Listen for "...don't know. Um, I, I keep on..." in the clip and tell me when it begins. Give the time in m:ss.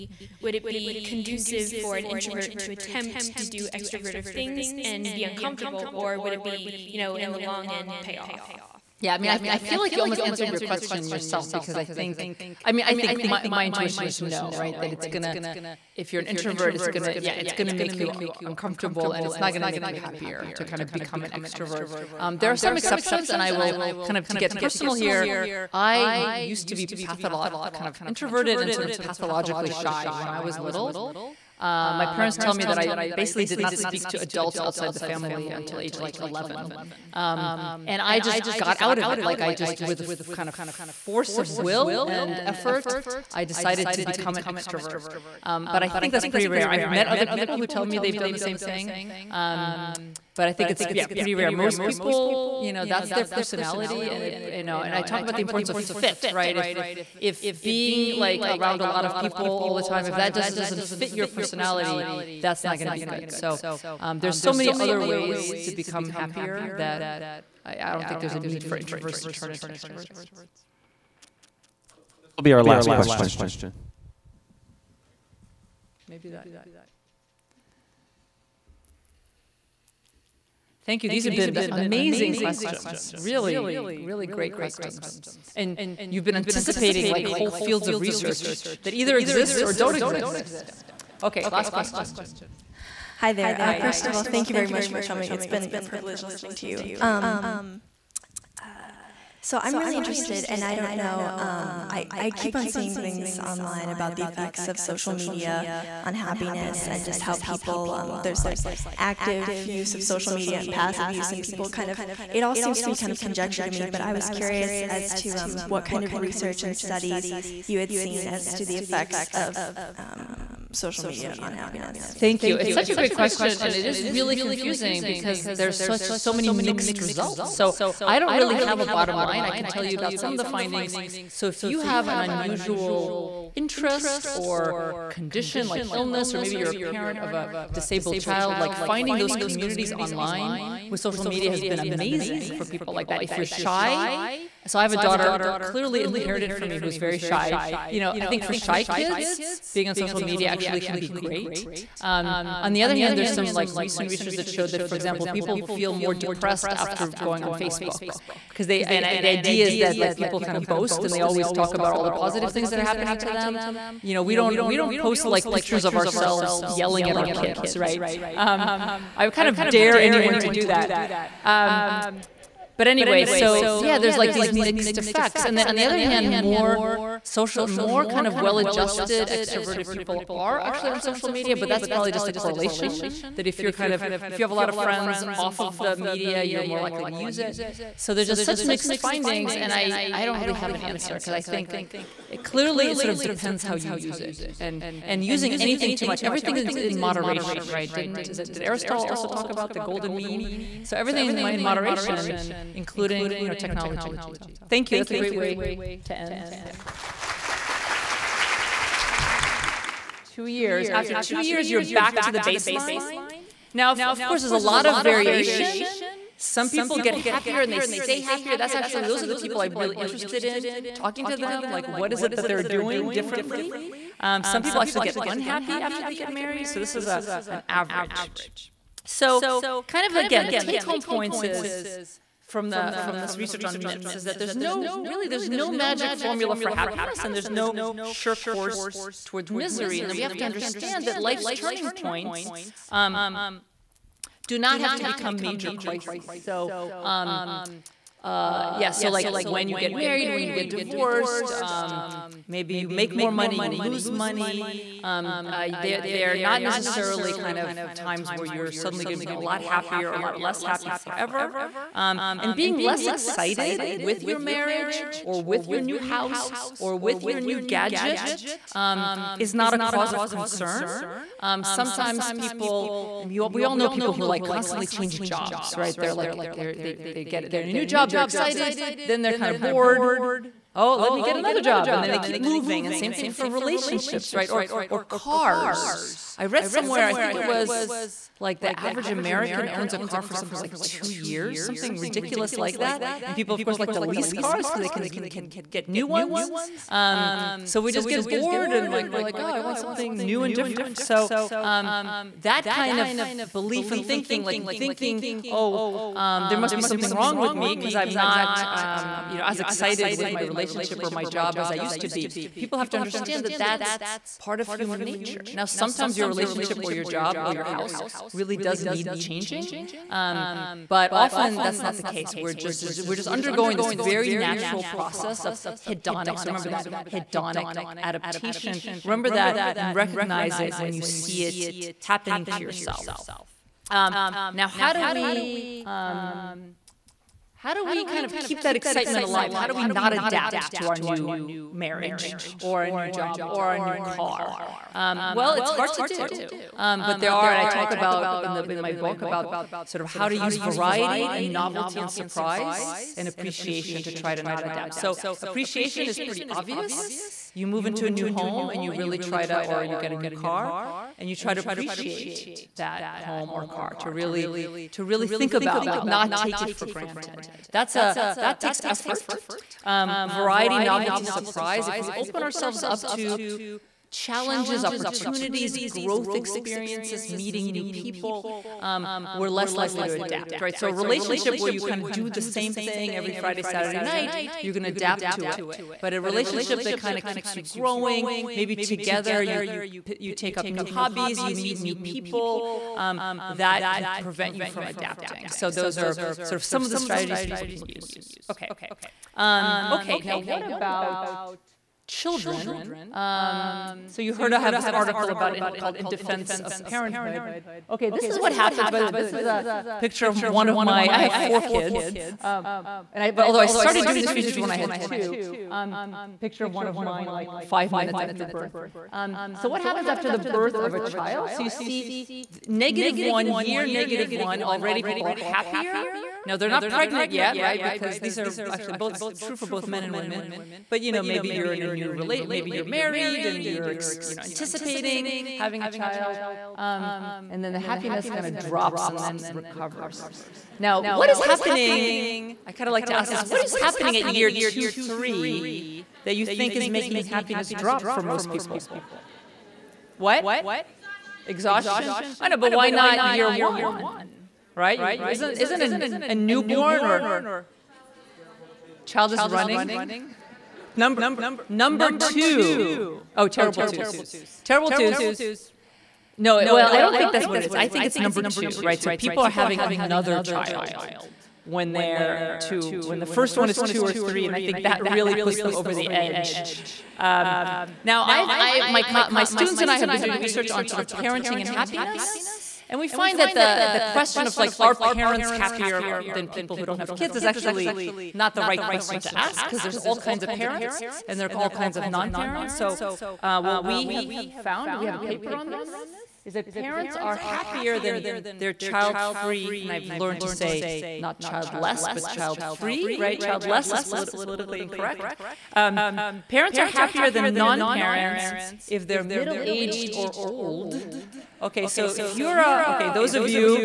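1:40.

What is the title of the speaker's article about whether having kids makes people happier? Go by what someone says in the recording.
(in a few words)
In Defense of Parenthood.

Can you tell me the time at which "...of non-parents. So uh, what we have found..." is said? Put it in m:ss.
8:11.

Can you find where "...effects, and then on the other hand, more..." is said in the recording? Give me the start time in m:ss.
2:54.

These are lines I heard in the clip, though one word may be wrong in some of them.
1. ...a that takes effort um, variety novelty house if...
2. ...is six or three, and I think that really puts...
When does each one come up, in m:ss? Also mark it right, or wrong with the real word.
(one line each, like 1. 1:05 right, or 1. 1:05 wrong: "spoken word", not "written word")
1. 6:07 wrong: "surprise", not "house"
2. 7:53 wrong: "two", not "six".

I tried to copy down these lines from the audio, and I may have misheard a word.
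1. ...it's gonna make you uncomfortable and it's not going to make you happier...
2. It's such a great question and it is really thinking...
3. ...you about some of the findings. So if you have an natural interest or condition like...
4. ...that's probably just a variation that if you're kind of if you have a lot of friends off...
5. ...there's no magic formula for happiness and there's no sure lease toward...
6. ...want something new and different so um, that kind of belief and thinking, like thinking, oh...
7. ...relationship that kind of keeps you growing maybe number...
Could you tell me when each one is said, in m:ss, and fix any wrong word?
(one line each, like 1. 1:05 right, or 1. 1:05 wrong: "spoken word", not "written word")
1. 0:17 right
2. 2:02 wrong: "confusing", not "thinking"
3. 2:09 wrong: "unusual", not "natural"
4. 3:01 wrong: "correlation", not "variation"
5. 3:55 wrong: "course", not "lease"
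6. 4:59 right
7. 6:26 wrong: "together", not "number".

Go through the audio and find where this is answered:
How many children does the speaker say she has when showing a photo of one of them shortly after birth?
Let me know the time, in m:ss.
6:51.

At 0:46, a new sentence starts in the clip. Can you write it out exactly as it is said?
I've met other people who tell me they've done the same thing.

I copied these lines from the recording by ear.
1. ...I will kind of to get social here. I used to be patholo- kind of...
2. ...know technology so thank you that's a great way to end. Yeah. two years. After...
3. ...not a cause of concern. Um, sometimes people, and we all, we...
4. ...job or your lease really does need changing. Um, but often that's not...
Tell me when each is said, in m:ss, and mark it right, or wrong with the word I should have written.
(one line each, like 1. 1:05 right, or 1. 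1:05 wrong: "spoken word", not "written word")
1. 0:23 wrong: "personal", not "social"
2. 3:23 right
3. 4:29 right
4. 5:17 wrong: "house", not "lease".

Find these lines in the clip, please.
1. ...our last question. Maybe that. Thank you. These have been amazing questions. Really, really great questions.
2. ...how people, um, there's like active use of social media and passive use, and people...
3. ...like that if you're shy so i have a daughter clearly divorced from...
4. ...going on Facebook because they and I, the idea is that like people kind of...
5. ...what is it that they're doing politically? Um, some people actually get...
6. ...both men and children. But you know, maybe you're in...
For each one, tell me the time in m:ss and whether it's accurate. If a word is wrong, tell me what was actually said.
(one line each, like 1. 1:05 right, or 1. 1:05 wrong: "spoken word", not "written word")
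1. 1:12 right
2. 1:47 right
3. 2:22 wrong: "inherited", not "divorced"
4. 2:37 right
5. 3:41 wrong: "differently", not "politically"
6. 7:09 wrong: "women", not "children".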